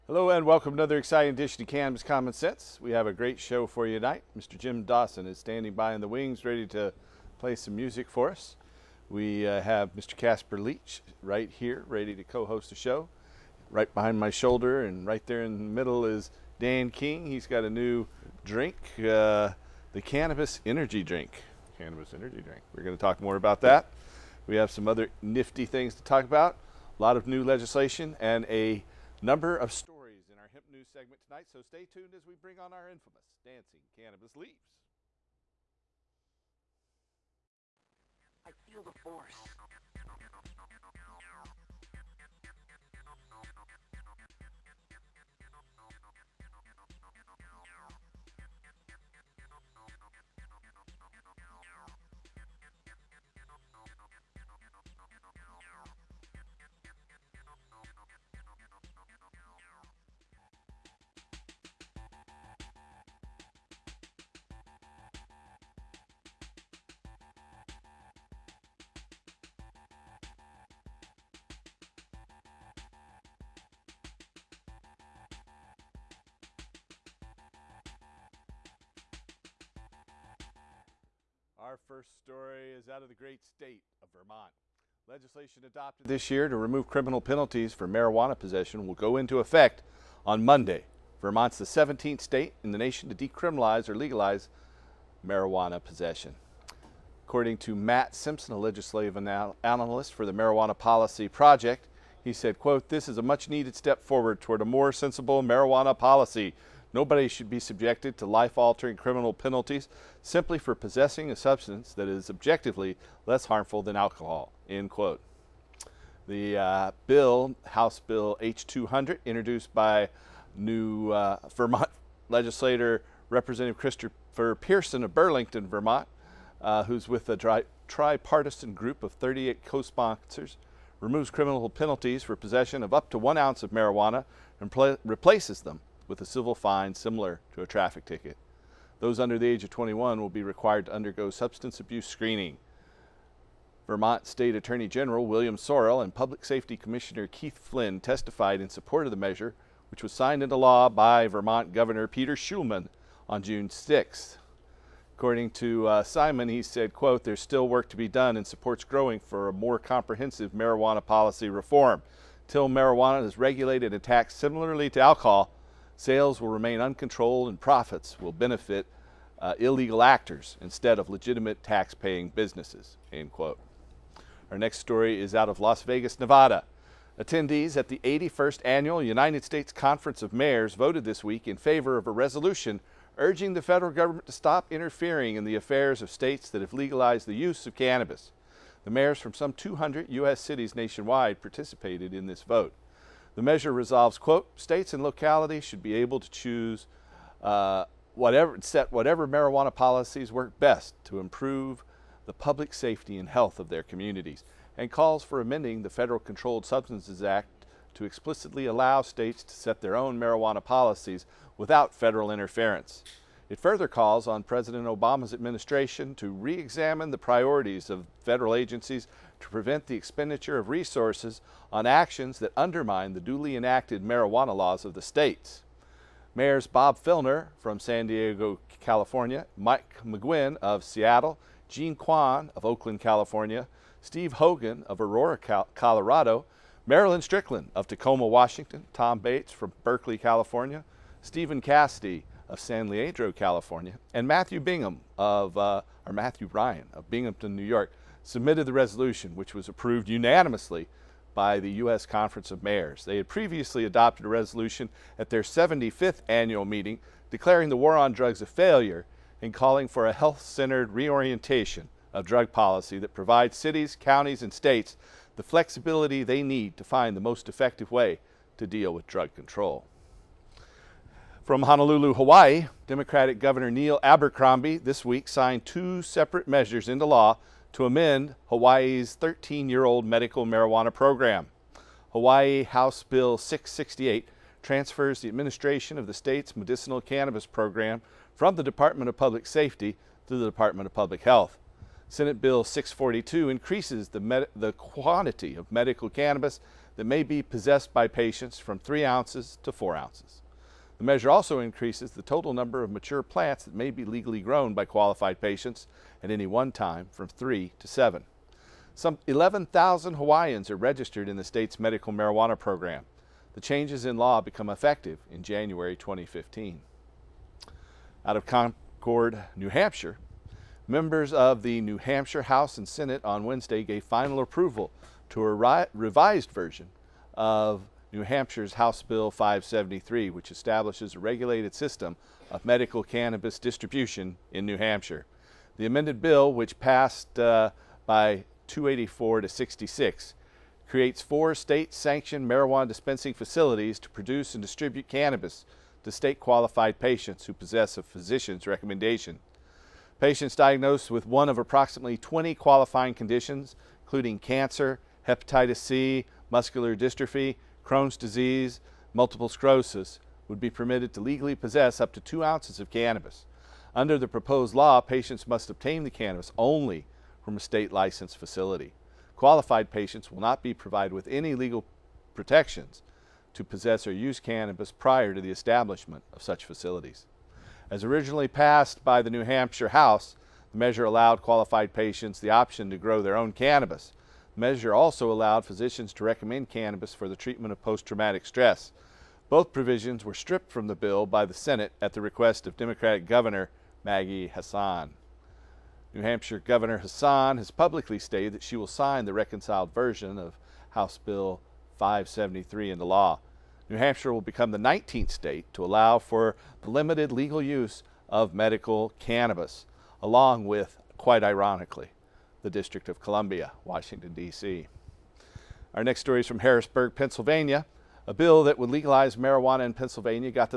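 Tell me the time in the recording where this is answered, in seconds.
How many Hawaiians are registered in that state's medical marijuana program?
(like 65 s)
309 s.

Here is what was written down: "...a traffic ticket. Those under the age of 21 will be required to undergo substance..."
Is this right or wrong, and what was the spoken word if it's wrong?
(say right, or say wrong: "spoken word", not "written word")
right.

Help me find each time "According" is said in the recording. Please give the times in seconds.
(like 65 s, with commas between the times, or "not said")
97 s, 155 s.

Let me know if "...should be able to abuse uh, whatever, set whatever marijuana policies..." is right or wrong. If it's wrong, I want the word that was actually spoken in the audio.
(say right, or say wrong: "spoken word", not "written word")
wrong: "choose", not "abuse".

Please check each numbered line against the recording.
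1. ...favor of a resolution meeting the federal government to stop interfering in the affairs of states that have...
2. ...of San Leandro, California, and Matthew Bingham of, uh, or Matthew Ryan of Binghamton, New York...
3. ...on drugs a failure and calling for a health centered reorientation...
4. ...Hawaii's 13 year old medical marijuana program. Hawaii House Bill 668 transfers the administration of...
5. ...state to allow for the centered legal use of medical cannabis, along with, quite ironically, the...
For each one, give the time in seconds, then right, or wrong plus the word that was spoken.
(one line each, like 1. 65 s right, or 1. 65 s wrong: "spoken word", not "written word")
1. 181 s wrong: "urging", not "meeting"
2. 242 s right
3. 257 s right
4. 278 s right
5. 405 s wrong: "limited", not "centered".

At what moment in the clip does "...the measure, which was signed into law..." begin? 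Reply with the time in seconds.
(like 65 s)
149 s.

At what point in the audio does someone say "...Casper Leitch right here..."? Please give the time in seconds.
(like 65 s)
10 s.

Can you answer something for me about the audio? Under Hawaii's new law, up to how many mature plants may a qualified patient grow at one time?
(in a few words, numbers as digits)
7.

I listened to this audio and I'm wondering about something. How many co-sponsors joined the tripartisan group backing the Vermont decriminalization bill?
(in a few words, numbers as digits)
38.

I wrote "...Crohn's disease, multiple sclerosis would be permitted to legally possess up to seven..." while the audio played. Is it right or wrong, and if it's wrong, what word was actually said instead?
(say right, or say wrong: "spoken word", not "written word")
wrong: "two", not "seven".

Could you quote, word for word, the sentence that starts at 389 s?
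Both provisions were stripped from the bill by the Senate at the request of Democratic Governor Maggie Hassan.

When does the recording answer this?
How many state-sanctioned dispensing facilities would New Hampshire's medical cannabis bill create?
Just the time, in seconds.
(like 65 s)
341 s.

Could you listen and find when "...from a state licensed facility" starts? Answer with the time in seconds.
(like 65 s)
367 s.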